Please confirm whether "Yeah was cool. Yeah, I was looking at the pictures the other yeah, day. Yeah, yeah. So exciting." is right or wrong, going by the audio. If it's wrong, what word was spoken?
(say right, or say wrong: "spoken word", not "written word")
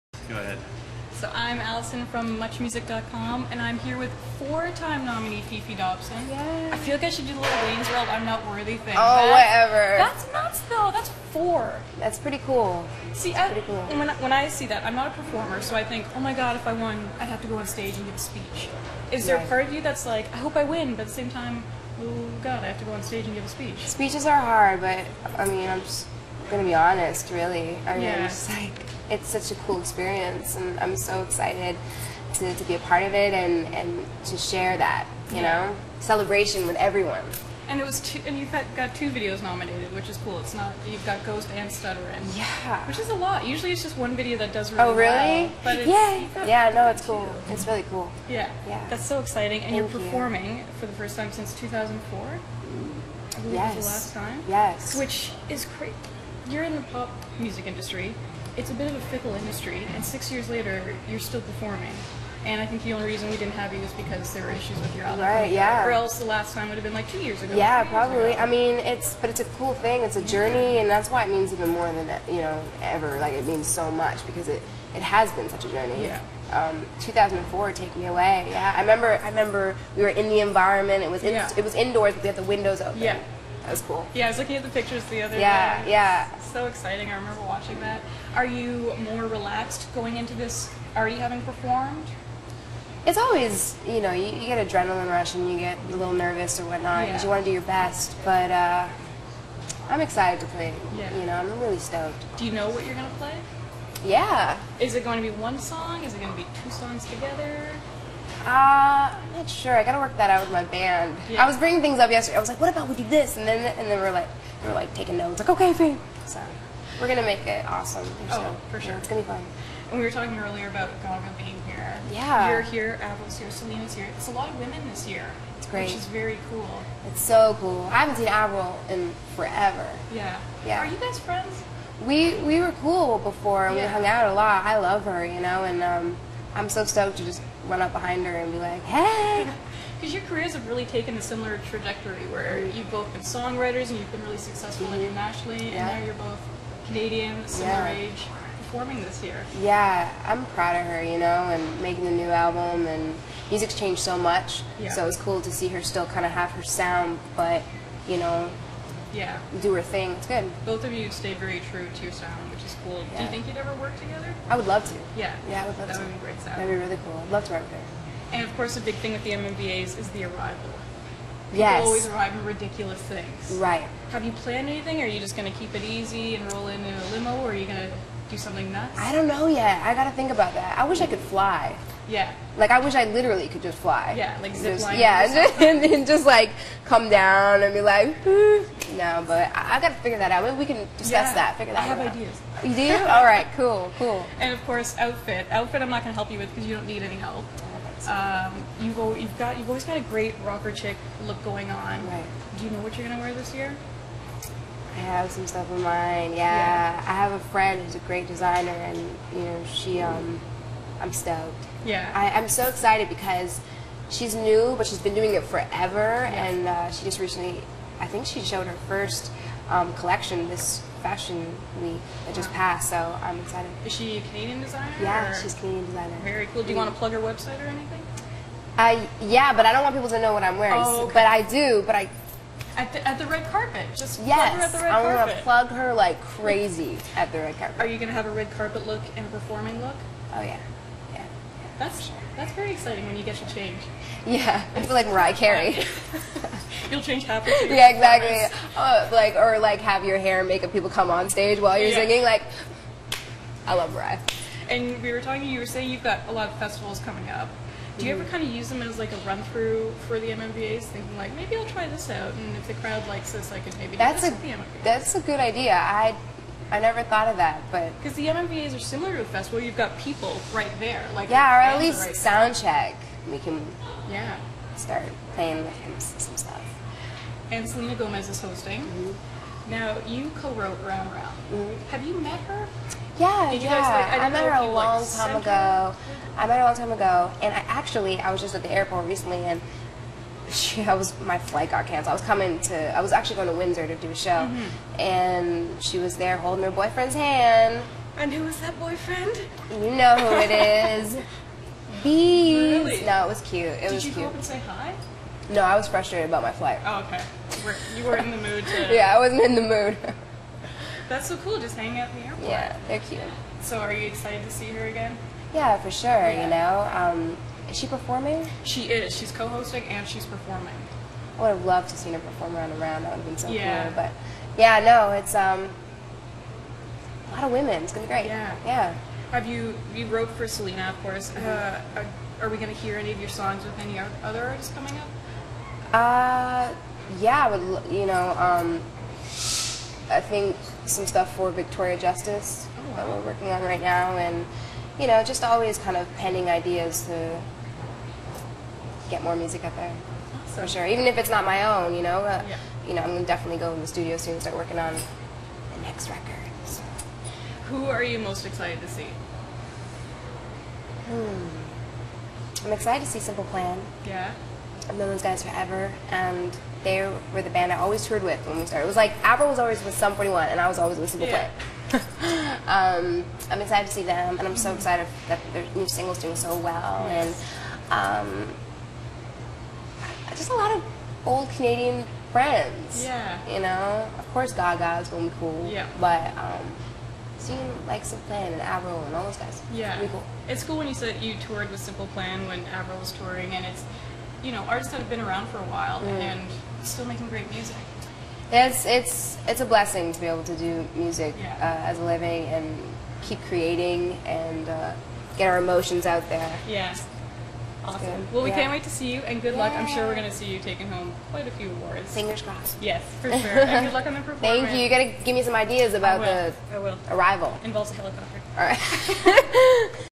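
right.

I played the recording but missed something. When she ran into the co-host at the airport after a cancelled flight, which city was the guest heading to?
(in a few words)
Windsor.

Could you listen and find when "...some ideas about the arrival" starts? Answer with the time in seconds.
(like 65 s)
415 s.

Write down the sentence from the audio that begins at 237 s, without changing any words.
Are you gonna have a red carpet look and a performing look?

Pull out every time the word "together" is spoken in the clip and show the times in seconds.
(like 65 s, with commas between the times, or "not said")
107 s, 163 s.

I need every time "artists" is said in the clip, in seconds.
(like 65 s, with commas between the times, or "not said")
334 s, 394 s.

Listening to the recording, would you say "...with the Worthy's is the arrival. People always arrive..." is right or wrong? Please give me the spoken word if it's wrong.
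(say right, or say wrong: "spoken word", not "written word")
wrong: "MMVA", not "Worthy".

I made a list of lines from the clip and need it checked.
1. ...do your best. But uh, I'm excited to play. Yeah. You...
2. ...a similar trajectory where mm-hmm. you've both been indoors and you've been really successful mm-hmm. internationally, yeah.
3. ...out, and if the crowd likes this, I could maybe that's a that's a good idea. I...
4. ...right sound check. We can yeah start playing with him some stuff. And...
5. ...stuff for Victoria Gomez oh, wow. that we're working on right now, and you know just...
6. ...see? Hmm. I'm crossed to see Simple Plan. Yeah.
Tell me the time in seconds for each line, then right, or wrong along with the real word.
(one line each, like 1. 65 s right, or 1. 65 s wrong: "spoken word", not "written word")
1. 97 s right
2. 141 s wrong: "songwriters", not "indoors"
3. 262 s right
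4. 271 s right
5. 341 s wrong: "Justice", not "Gomez"
6. 358 s wrong: "excited", not "crossed".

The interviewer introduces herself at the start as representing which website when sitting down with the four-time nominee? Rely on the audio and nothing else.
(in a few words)
MuchMusic.com.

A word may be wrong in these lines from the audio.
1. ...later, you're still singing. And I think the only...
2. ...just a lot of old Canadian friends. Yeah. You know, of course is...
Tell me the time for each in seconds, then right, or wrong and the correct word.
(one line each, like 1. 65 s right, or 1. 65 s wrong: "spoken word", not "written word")
1. 60 s wrong: "performing", not "singing"
2. 380 s right.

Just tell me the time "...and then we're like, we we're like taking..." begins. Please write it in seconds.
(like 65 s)
113 s.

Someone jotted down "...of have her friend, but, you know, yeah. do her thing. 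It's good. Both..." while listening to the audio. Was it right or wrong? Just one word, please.
wrong.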